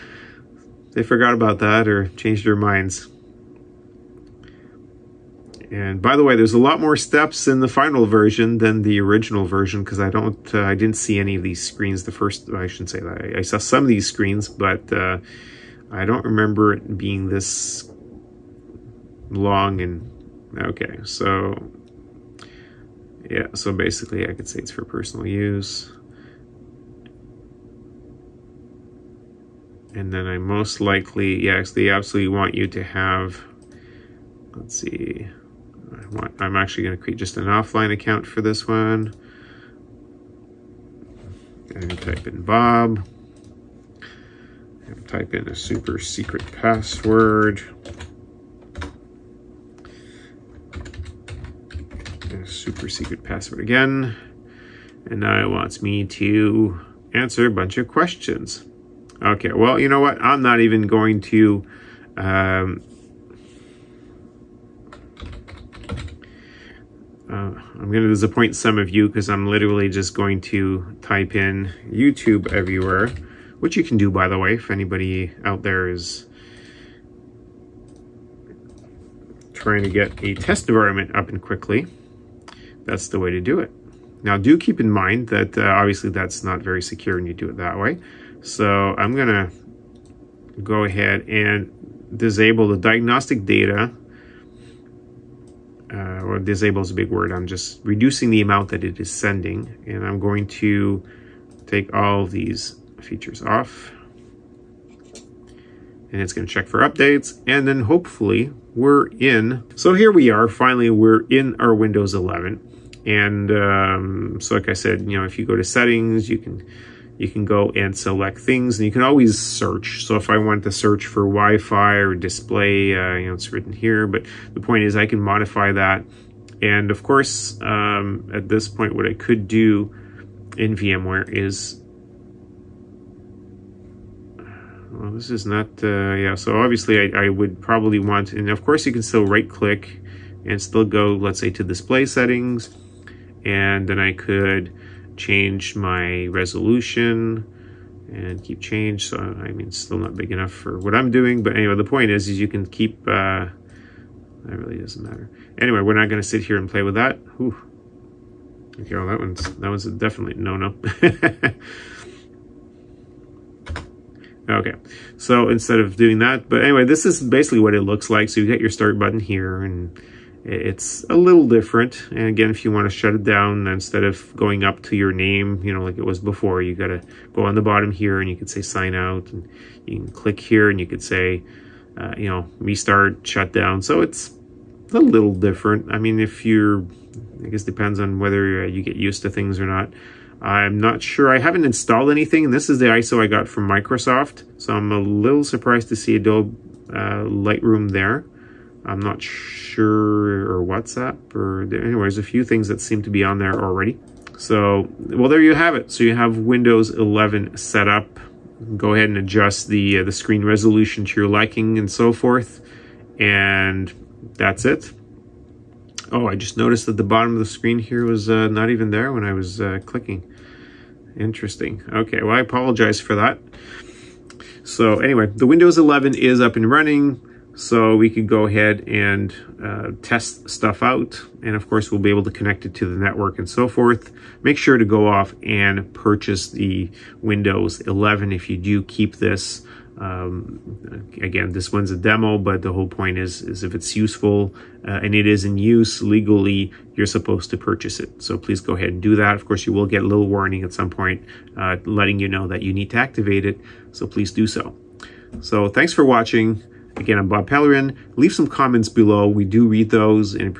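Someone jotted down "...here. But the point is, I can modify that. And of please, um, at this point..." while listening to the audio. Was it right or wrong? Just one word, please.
wrong.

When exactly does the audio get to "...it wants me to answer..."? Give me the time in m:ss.
0:55.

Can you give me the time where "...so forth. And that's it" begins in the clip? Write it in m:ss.
3:31.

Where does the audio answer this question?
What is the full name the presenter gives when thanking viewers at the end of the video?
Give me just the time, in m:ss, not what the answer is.
4:17.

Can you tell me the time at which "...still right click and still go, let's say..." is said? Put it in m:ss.
2:19.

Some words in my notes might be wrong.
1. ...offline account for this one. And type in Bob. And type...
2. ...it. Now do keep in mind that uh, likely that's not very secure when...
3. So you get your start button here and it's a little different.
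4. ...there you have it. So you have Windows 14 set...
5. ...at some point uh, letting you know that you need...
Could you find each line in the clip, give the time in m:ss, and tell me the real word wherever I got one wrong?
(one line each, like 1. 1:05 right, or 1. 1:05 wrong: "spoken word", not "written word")
1. 0:37 right
2. 1:23 wrong: "obviously", not "likely"
3. 2:48 right
4. 3:25 wrong: "11", not "14"
5. 4:10 right.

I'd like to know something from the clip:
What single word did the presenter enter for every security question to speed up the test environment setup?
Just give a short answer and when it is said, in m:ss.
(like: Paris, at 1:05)
YouTube, at 1:11.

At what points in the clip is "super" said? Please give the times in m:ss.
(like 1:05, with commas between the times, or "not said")
0:45, 0:52.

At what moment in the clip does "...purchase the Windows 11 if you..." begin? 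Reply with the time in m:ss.
3:55.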